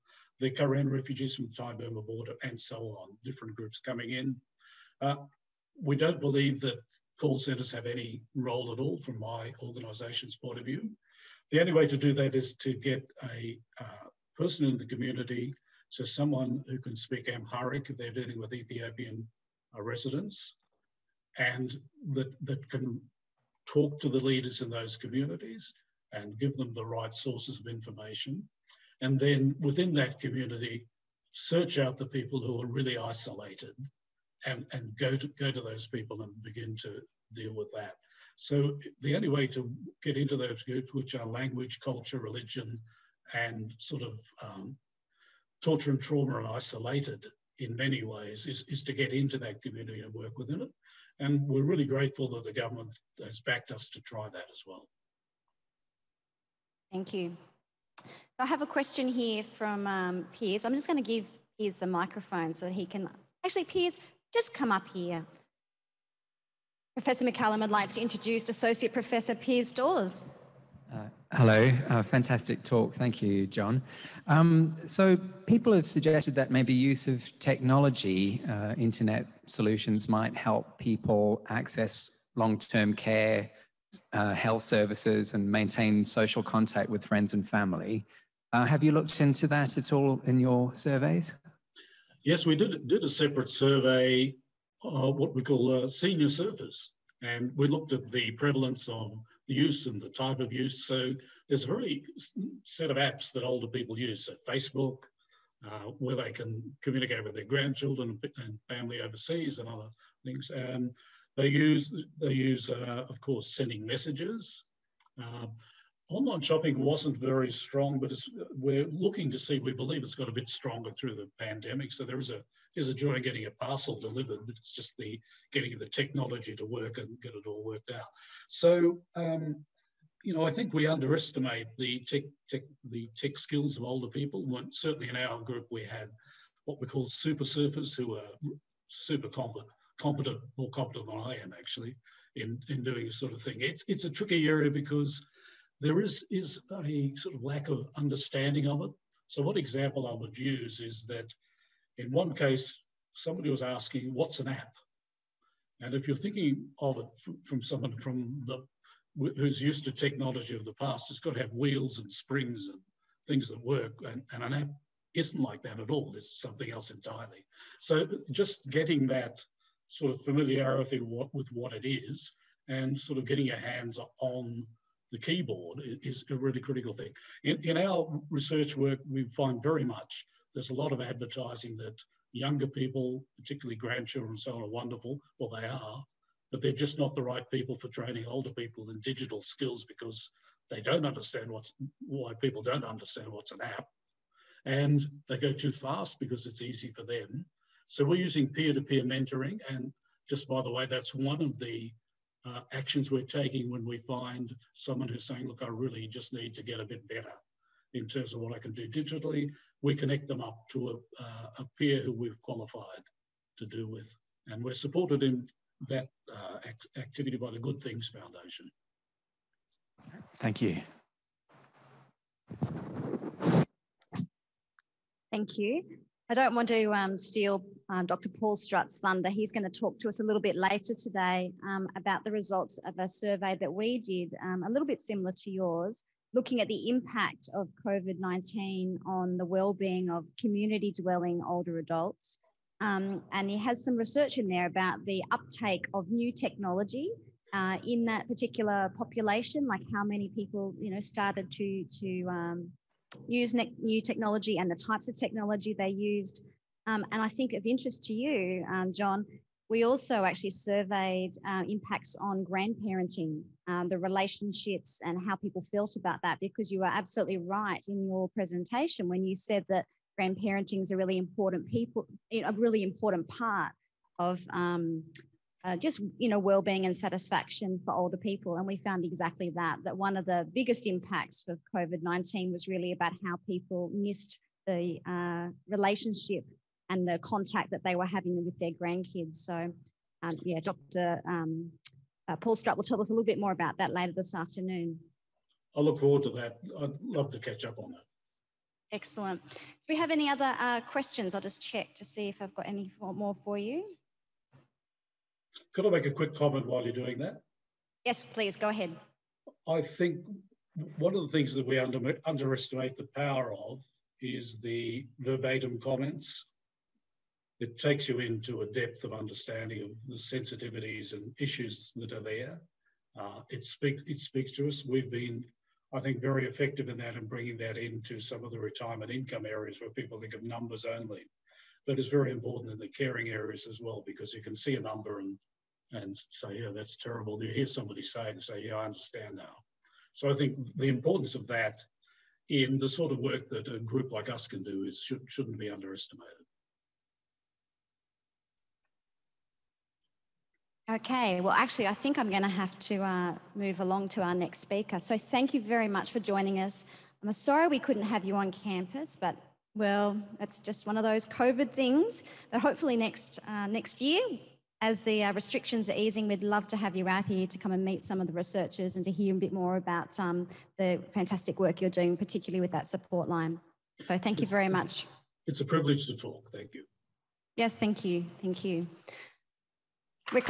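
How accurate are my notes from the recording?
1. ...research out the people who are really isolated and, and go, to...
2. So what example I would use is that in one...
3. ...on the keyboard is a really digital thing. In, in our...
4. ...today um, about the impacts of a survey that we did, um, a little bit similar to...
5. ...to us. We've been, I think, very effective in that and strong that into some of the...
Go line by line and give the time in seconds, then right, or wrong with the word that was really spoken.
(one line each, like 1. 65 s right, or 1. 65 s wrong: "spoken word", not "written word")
1. 31 s wrong: "search", not "research"
2. 149 s right
3. 174 s wrong: "critical", not "digital"
4. 230 s wrong: "results", not "impacts"
5. 324 s wrong: "bringing", not "strong".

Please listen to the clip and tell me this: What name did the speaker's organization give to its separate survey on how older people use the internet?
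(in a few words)
senior surfers.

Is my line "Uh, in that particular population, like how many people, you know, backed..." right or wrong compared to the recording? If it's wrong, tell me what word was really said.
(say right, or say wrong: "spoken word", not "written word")
wrong: "started", not "backed".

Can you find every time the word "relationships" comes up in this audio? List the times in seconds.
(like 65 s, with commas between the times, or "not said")
263 s, 285 s.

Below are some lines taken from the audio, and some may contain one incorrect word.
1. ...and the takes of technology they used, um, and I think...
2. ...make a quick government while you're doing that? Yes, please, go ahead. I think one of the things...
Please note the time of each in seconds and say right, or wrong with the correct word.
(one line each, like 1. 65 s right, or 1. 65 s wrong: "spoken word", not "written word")
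1. 254 s wrong: "types", not "takes"
2. 305 s wrong: "comment", not "government".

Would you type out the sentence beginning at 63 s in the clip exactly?
Actually, Piers, just come up here.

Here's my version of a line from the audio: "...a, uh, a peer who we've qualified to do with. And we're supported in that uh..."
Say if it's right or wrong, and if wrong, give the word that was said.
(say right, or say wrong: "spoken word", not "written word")
right.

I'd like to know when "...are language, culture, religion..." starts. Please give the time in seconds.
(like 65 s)
41 s.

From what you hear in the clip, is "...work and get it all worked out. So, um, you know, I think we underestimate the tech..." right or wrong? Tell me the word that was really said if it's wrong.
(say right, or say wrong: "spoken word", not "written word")
right.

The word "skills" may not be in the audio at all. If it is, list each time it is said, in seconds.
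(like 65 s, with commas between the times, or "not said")
133 s, 189 s.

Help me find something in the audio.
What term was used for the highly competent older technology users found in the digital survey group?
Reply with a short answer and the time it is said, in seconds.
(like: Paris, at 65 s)
super surfers, at 137 s.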